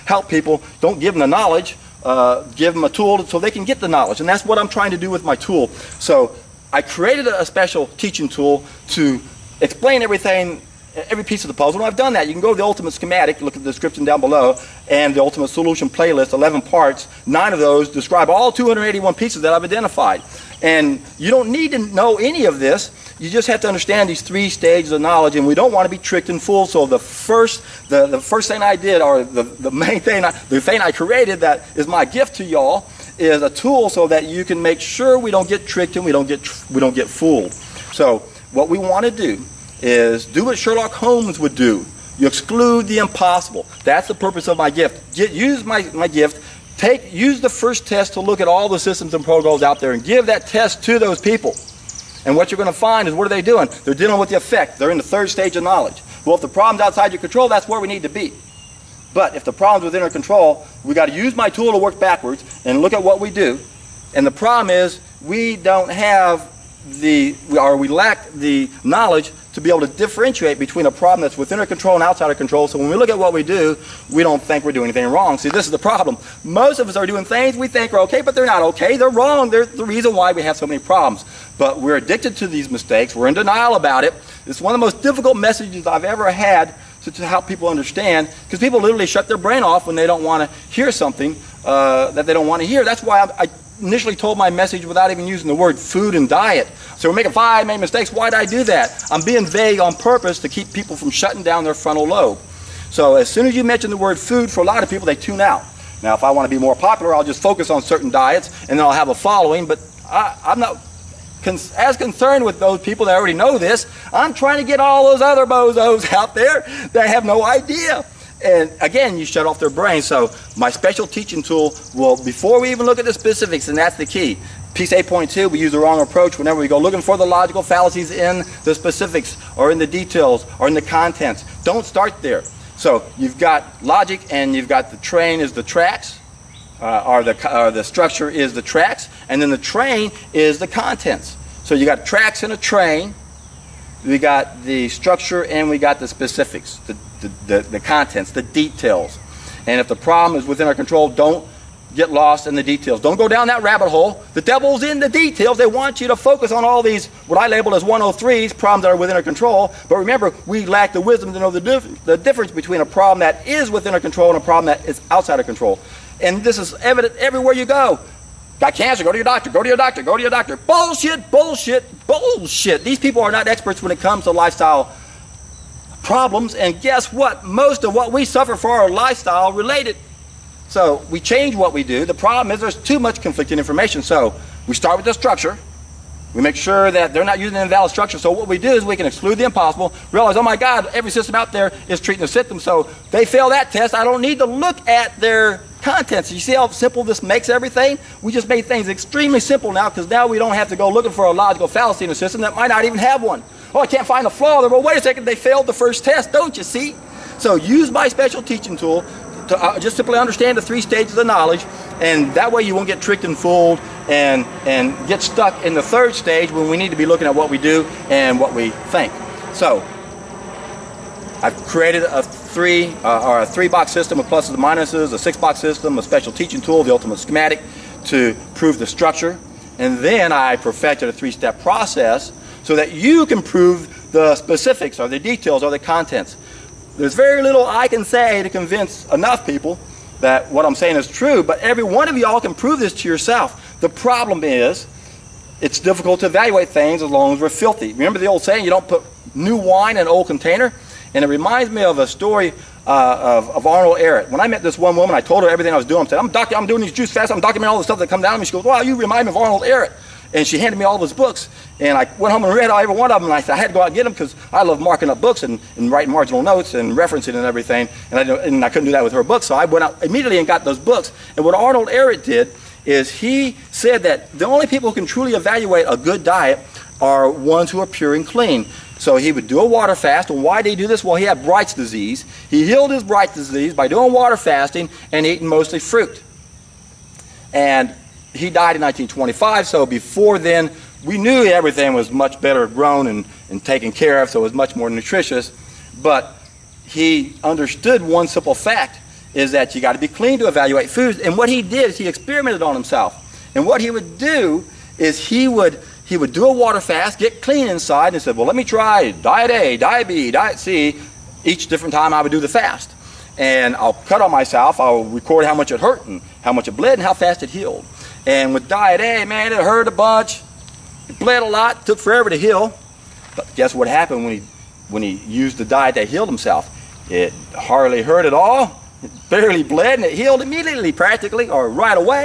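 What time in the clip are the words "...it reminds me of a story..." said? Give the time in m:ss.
4:11.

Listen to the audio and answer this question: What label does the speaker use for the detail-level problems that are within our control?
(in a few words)
103s.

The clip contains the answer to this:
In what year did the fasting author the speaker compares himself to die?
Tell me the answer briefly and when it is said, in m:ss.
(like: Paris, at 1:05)
1925, at 4:48.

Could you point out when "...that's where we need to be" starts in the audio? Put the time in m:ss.
0:57.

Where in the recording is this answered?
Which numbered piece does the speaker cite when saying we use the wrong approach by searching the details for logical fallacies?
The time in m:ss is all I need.
2:04.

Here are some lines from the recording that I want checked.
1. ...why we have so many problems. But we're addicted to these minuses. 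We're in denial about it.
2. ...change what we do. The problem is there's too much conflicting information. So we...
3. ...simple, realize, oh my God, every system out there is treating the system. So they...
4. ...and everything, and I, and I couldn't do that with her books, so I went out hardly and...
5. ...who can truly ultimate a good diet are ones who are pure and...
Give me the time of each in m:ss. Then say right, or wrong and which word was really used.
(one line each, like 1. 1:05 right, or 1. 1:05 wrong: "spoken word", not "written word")
1. 1:20 wrong: "mistakes", not "minuses"
2. 3:01 right
3. 3:09 wrong: "impossible", not "simple"
4. 4:27 wrong: "immediately", not "hardly"
5. 4:34 wrong: "evaluate", not "ultimate".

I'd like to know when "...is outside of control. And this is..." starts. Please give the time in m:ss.
2:44.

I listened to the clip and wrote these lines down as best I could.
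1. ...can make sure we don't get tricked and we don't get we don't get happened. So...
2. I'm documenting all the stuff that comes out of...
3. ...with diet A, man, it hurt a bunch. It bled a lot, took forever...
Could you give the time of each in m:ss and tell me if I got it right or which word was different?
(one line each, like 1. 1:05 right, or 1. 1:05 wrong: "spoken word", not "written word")
1. 0:34 wrong: "fooled", not "happened"
2. 4:17 right
3. 5:18 right.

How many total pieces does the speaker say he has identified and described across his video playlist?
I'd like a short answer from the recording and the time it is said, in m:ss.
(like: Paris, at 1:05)
281, at 0:18.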